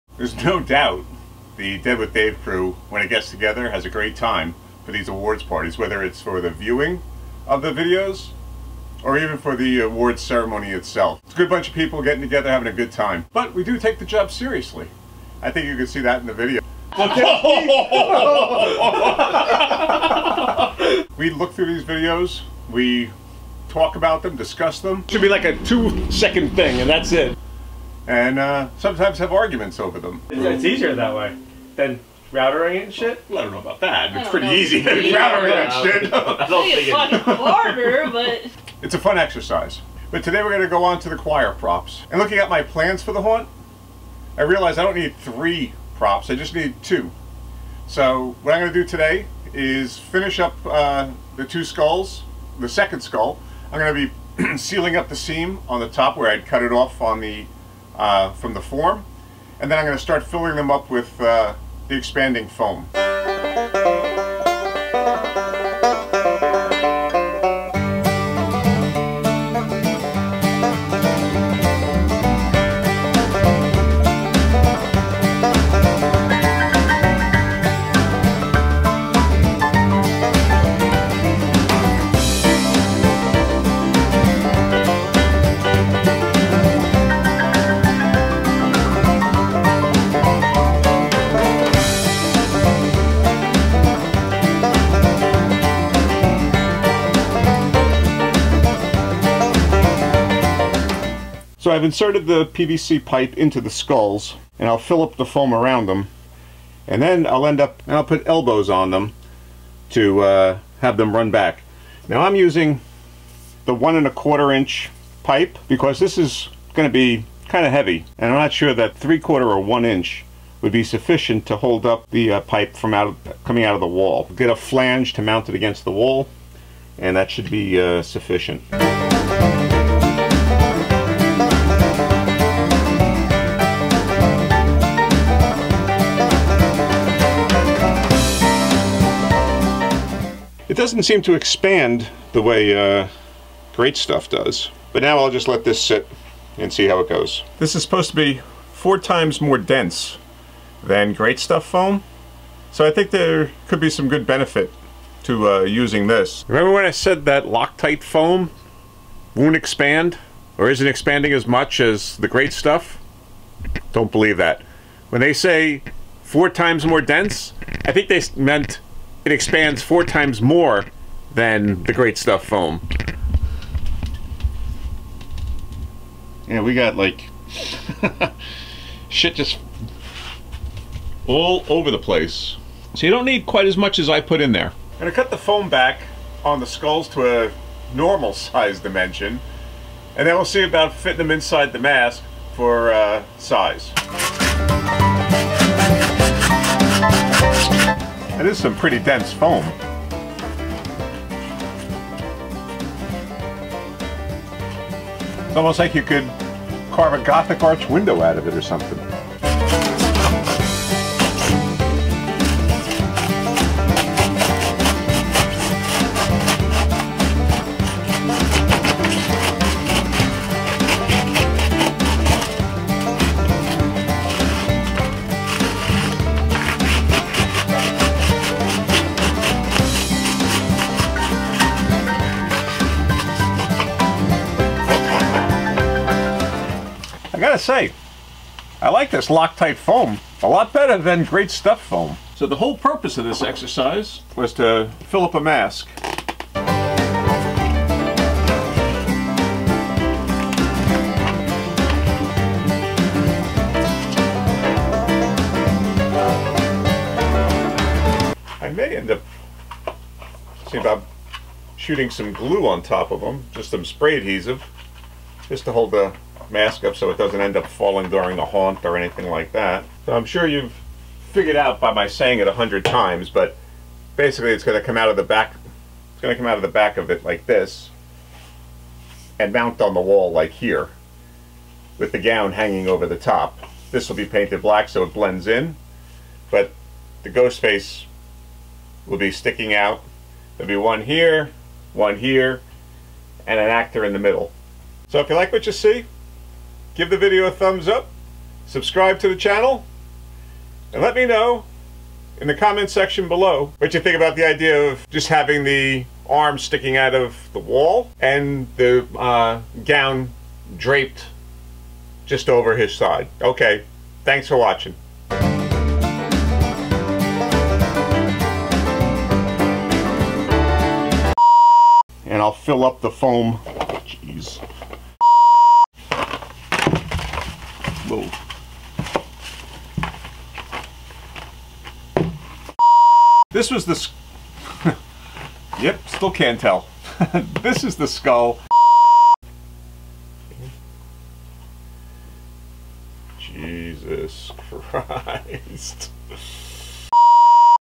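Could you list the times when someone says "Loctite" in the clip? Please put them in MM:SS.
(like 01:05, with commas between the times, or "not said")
02:37, 03:59.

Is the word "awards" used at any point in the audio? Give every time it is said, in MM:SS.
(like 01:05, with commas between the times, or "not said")
00:05, 00:09.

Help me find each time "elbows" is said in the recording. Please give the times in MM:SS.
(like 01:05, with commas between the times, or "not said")
01:48.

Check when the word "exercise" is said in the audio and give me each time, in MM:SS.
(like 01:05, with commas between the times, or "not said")
00:39, 04:03.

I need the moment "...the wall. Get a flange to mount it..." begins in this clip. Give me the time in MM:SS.
02:03.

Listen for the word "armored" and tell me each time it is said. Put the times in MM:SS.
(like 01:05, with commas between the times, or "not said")
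not said.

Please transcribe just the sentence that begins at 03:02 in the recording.
So you don't need quite as much as I put in there.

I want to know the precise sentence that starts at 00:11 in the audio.
It's a good bunch of people getting together, having a good time.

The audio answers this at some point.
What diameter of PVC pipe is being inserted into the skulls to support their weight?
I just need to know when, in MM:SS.
01:53.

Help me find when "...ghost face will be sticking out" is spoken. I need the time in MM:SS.
04:47.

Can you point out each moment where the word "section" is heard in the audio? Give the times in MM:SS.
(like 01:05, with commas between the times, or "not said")
05:02.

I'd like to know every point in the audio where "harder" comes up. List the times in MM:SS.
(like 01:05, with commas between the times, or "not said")
00:37.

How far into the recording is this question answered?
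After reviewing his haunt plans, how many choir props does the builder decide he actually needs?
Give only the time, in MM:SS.
00:46.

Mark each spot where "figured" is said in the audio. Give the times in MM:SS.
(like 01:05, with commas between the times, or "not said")
04:31.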